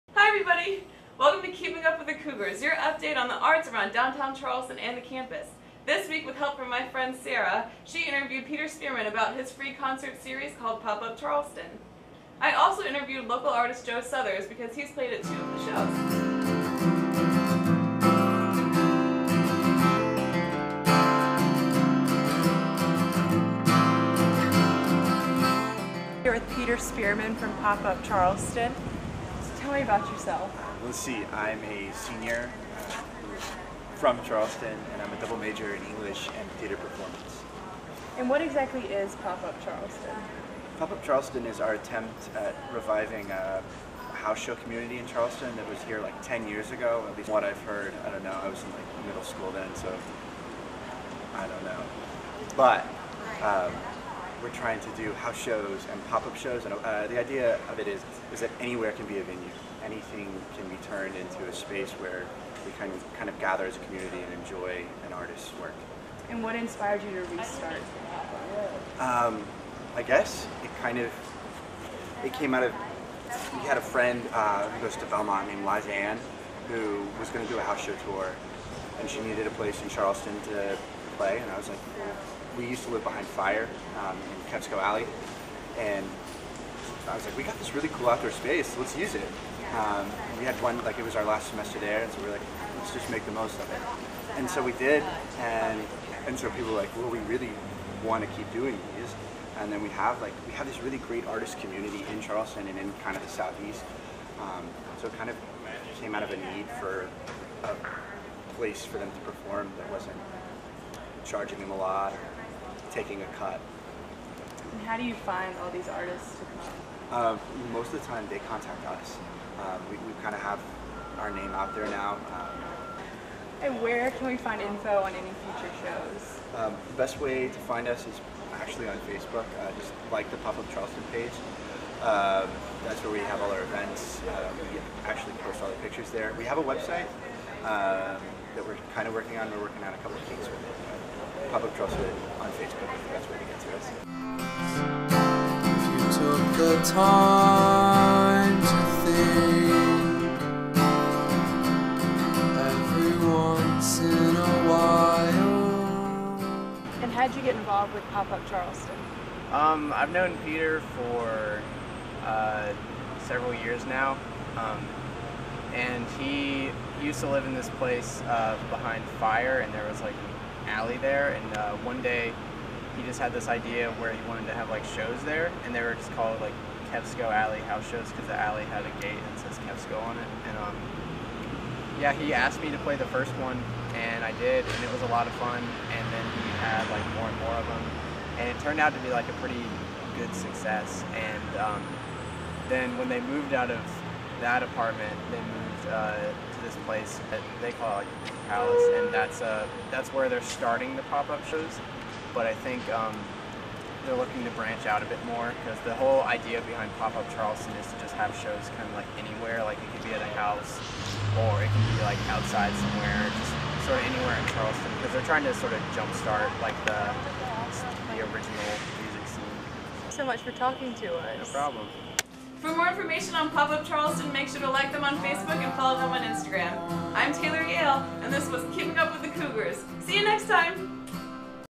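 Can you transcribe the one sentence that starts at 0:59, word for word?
Anything can be turned into a space where we can kind of gather as a community and enjoy an artist's work.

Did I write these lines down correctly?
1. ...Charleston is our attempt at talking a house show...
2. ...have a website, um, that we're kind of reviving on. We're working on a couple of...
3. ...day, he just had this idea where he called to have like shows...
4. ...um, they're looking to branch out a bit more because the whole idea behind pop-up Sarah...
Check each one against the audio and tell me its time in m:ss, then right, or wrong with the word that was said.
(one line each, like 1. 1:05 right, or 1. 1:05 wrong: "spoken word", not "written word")
1. 0:41 wrong: "reviving", not "talking"
2. 2:16 wrong: "working", not "reviving"
3. 2:52 wrong: "wanted", not "called"
4. 3:22 wrong: "Charleston", not "Sarah".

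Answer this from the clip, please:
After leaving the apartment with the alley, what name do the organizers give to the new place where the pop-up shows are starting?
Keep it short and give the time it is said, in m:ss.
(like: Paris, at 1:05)
Palace, at 3:18.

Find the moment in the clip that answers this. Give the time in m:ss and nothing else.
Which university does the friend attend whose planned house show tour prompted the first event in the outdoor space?
1:15.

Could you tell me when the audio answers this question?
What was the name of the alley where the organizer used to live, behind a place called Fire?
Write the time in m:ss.
1:24.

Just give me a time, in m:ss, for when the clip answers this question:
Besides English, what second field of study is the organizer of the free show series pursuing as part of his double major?
0:36.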